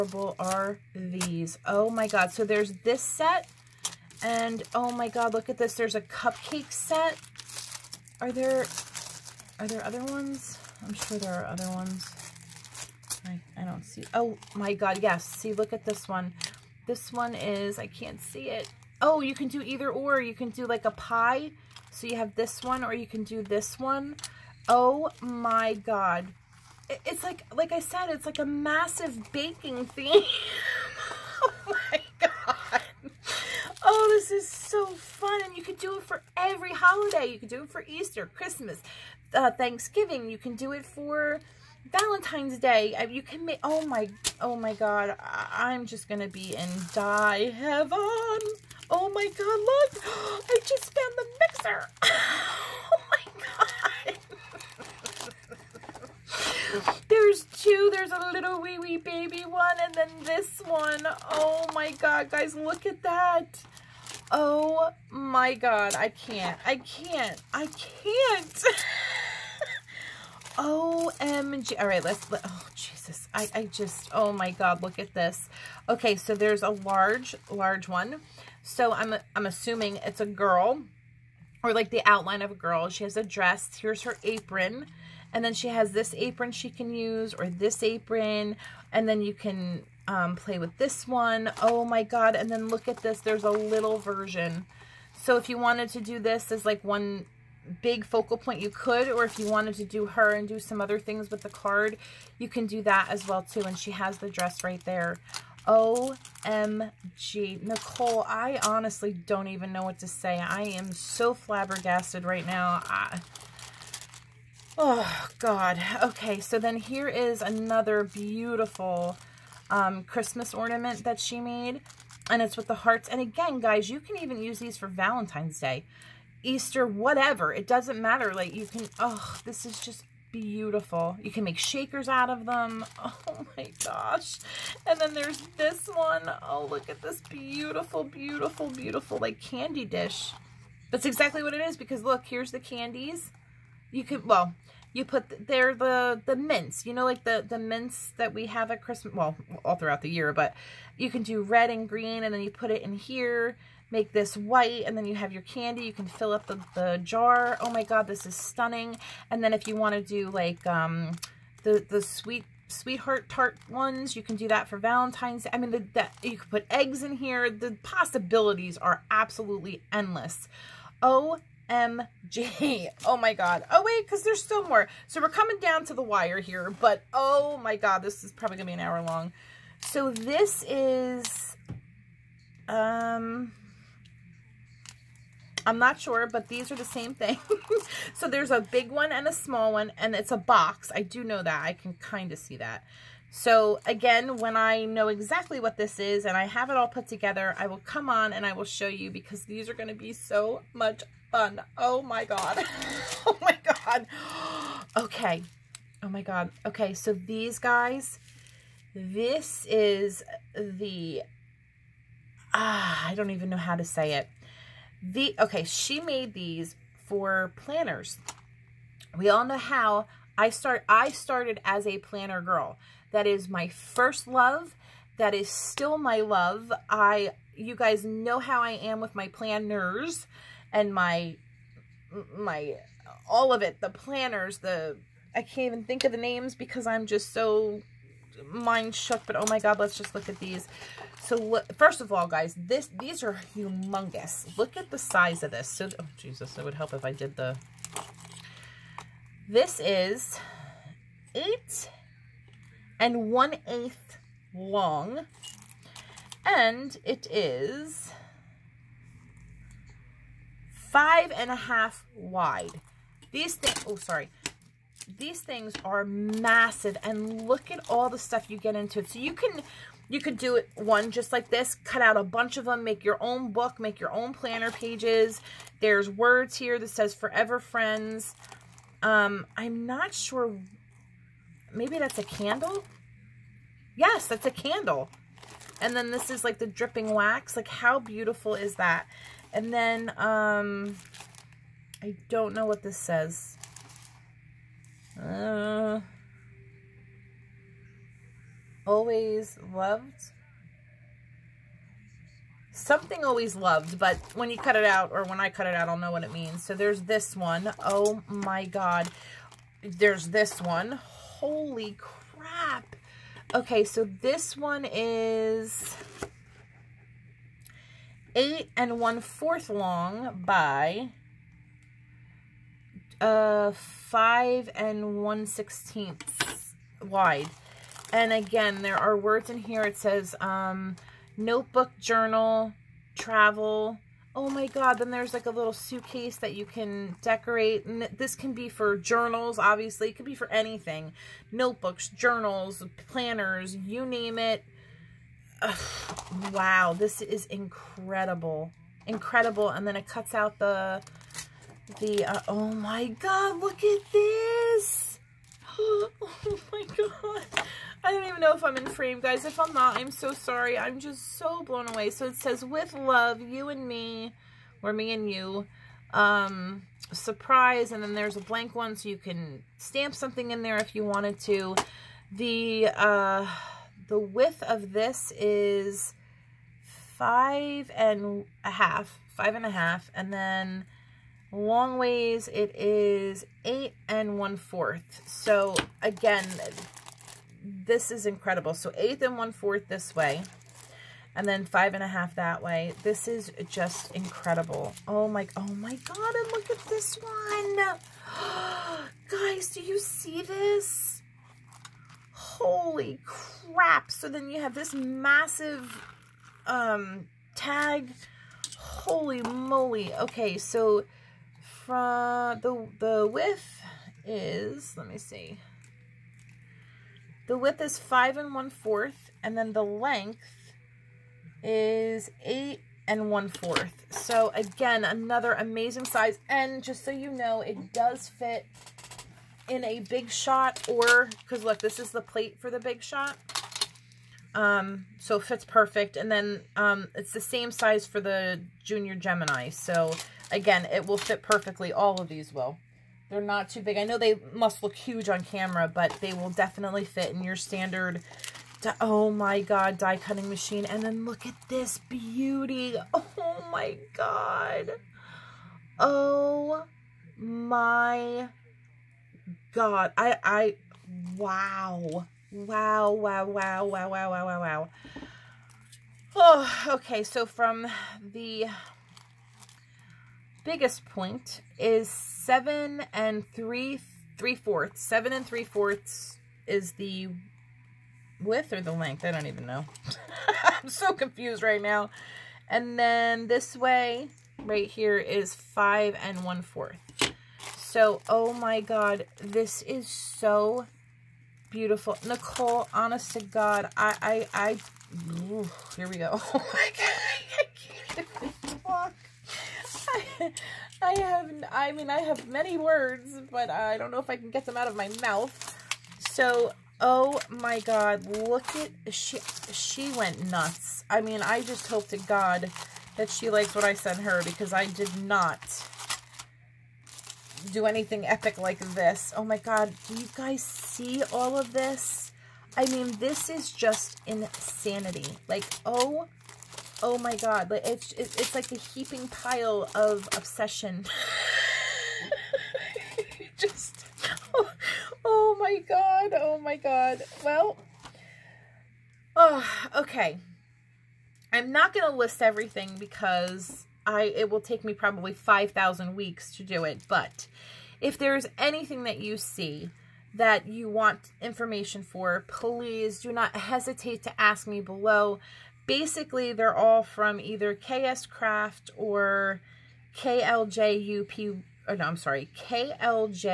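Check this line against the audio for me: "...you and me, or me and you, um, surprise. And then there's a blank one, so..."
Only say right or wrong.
right.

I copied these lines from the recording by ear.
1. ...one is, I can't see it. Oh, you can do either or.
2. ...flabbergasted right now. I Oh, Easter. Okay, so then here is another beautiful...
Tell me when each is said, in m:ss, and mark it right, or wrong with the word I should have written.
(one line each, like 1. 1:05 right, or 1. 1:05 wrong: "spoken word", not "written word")
1. 0:17 right
2. 1:51 wrong: "God", not "Easter".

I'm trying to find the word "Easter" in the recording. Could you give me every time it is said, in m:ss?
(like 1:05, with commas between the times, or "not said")
0:37, 2:06.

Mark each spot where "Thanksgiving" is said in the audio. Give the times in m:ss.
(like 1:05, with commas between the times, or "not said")
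0:39.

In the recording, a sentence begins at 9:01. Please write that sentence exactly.
I'm not going to list everything because I it will take me probably 5,000 weeks to do it.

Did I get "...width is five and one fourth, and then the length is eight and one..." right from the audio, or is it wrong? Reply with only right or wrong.
right.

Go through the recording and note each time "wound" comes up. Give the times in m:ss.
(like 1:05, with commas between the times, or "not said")
not said.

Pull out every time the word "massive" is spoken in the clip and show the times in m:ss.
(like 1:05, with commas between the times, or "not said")
0:28, 4:26, 6:44.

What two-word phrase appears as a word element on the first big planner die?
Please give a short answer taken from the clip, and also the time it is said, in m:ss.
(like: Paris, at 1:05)
Forever friends, at 4:37.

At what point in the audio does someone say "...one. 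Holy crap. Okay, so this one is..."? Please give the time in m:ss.
5:10.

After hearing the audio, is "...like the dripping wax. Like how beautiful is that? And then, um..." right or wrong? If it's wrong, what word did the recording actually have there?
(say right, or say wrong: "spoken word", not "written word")
right.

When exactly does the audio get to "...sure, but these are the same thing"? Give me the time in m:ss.
3:05.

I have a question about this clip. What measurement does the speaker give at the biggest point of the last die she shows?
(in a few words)
7 3/4.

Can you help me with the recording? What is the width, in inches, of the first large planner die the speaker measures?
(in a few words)
5 1/2.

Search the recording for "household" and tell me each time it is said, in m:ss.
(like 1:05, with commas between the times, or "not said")
not said.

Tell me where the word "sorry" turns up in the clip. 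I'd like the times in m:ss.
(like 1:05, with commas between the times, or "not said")
4:23, 6:00, 9:22.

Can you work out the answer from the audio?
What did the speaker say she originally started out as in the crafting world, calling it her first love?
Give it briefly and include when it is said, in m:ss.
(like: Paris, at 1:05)
A planner girl, at 3:41.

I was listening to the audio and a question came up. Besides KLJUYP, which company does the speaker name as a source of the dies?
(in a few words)
KS Craft.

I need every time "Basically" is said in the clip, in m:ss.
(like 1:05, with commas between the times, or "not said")
9:15.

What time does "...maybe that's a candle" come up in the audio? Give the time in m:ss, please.
4:41.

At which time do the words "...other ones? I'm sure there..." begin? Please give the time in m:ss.
0:09.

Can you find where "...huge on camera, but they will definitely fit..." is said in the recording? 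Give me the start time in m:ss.
7:24.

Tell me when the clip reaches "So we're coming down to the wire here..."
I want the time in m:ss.
2:55.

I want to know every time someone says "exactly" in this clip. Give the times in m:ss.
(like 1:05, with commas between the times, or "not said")
2:21, 3:15.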